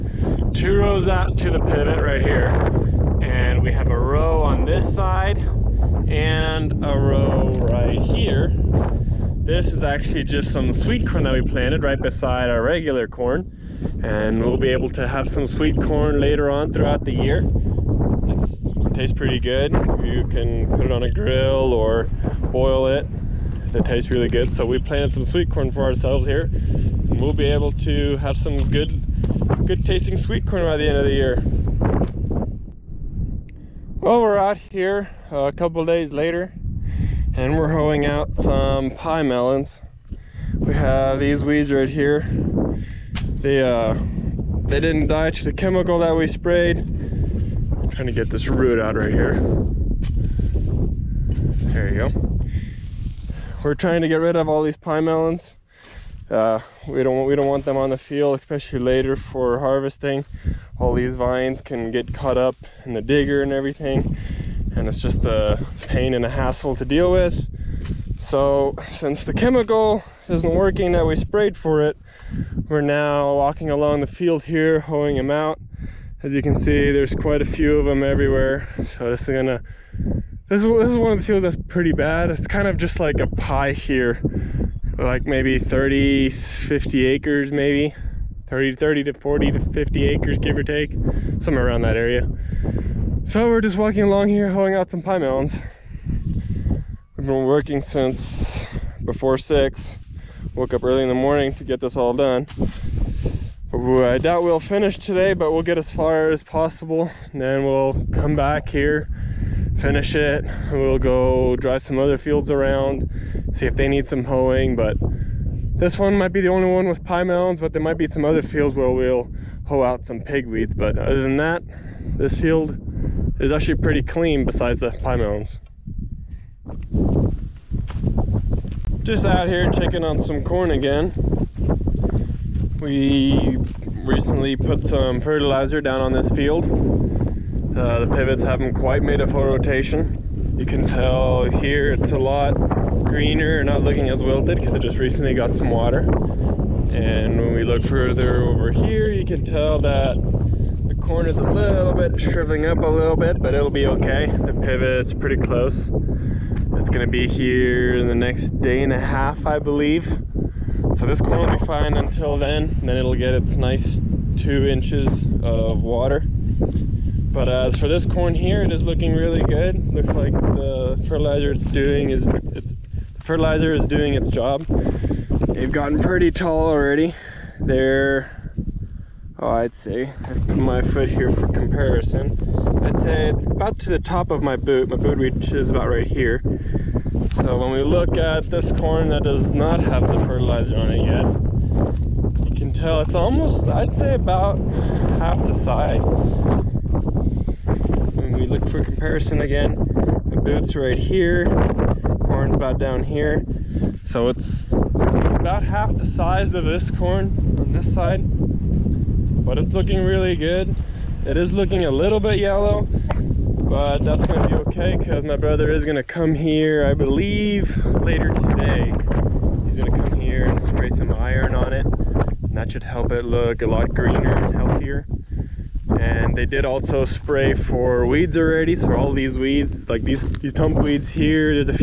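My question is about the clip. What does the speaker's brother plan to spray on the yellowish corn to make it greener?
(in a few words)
iron.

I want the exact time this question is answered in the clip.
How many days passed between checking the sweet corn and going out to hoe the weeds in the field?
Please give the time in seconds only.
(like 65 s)
35 s.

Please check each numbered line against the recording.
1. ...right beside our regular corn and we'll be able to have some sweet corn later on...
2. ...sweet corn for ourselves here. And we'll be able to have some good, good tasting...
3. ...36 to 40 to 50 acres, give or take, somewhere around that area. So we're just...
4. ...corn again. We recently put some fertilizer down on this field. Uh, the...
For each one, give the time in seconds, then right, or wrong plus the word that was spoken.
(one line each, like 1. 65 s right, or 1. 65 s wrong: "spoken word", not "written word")
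1. 11 s right
2. 25 s right
3. 88 s wrong: "30", not "36"
4. 130 s right.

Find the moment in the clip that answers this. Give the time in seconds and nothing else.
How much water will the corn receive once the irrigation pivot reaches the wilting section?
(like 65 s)
164 s.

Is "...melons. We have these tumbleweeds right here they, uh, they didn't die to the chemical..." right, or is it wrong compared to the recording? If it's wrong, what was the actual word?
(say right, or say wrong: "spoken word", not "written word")
wrong: "weeds", not "tumbleweeds".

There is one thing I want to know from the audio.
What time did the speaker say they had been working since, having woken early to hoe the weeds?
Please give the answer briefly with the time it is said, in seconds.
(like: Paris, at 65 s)
before 6, at 99 s.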